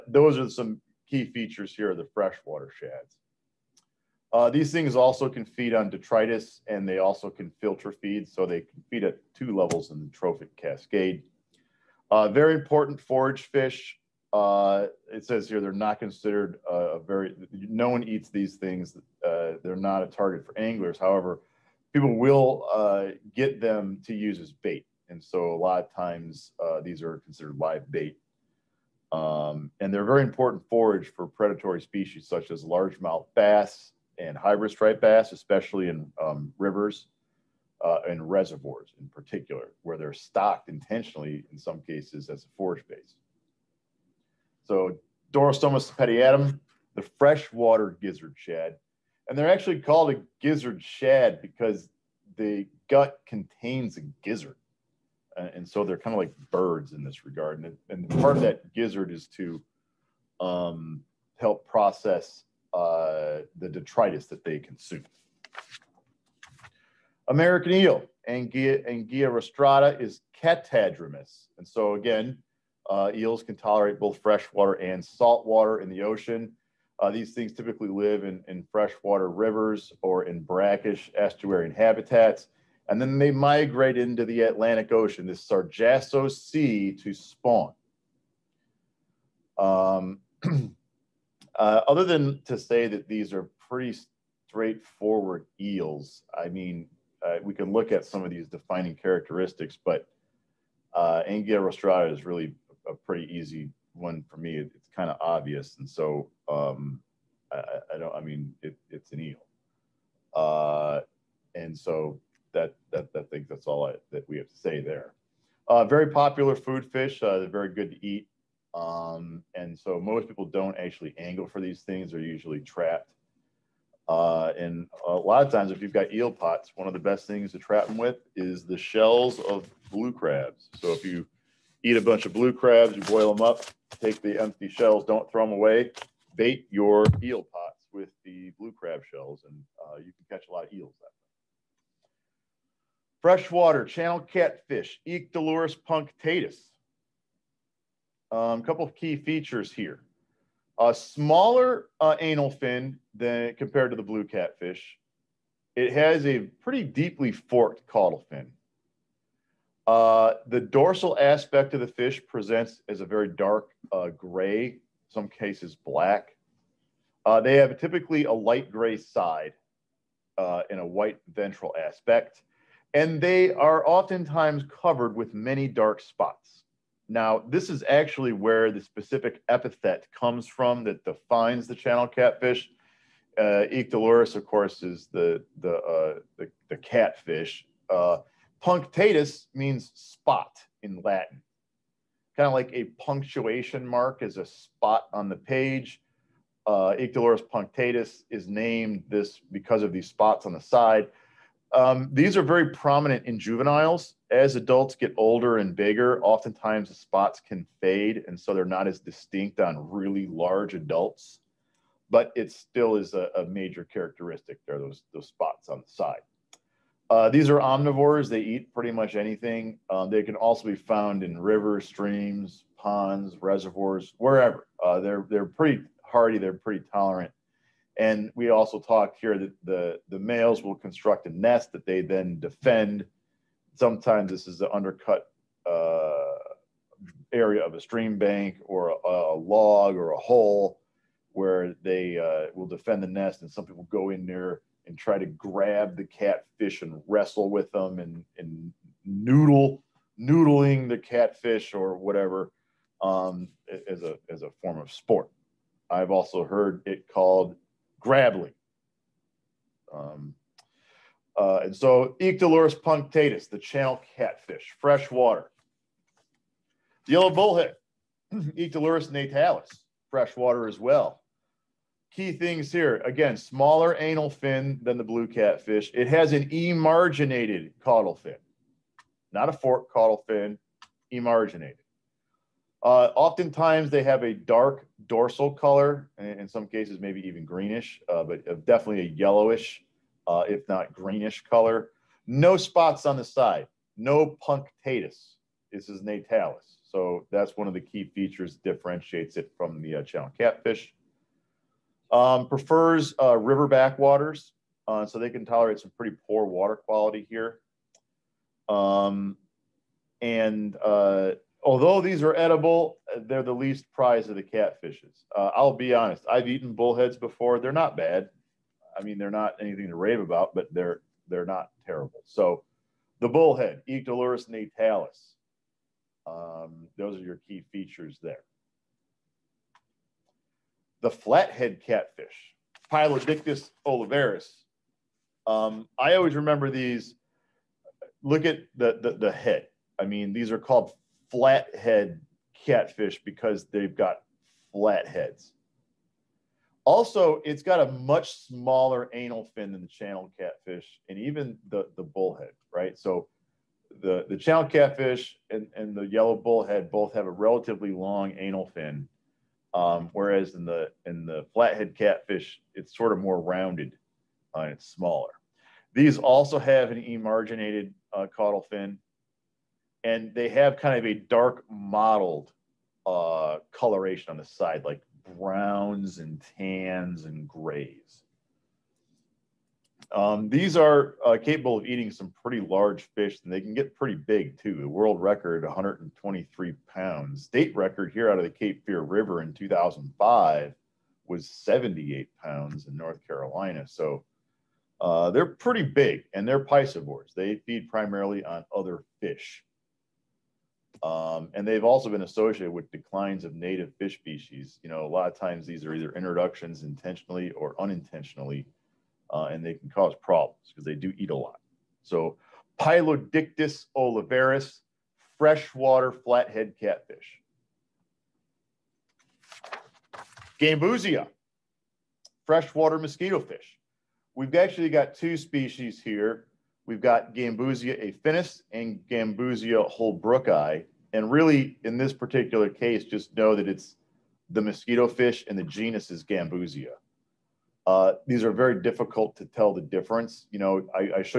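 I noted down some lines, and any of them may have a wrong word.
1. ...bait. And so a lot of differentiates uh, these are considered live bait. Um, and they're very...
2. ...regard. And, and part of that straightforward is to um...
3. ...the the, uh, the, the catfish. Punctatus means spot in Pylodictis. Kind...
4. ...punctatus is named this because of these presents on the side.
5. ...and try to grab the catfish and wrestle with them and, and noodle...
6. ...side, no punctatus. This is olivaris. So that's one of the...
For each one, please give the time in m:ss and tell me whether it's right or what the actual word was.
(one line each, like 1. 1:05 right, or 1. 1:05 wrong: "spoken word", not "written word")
1. 0:24 wrong: "times", not "differentiates"
2. 0:57 wrong: "gizzard", not "straightforward"
3. 3:05 wrong: "Latin", not "Pylodictis"
4. 3:17 wrong: "spots", not "presents"
5. 4:04 right
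6. 4:53 wrong: "natalis", not "olivaris".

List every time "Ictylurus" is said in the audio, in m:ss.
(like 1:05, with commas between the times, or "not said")
4:22, 4:28.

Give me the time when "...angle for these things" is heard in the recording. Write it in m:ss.
2:01.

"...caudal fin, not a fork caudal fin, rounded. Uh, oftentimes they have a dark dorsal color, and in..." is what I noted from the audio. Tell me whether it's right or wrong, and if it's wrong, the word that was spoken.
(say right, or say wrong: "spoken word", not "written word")
wrong: "emarginated", not "rounded".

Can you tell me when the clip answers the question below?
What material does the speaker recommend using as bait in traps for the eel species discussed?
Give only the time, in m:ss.
2:08.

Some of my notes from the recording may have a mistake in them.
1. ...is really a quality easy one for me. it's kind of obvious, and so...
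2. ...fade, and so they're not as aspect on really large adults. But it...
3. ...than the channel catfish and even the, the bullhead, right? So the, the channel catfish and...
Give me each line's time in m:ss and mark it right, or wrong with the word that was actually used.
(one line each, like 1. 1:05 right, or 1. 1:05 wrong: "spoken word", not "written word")
1. 1:42 wrong: "pretty", not "quality"
2. 3:27 wrong: "distinct", not "aspect"
3. 5:49 right.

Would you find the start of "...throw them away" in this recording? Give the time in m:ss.
2:15.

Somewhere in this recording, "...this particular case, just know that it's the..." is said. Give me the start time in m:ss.
7:11.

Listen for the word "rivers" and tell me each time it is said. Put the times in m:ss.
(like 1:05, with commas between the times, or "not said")
0:36, 1:19, 3:41, 5:03, 6:29.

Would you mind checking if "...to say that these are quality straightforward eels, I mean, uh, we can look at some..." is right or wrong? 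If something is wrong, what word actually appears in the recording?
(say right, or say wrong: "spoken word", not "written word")
wrong: "pretty", not "quality".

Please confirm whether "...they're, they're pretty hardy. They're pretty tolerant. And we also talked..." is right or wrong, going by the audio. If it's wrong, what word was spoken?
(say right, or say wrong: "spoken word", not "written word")
right.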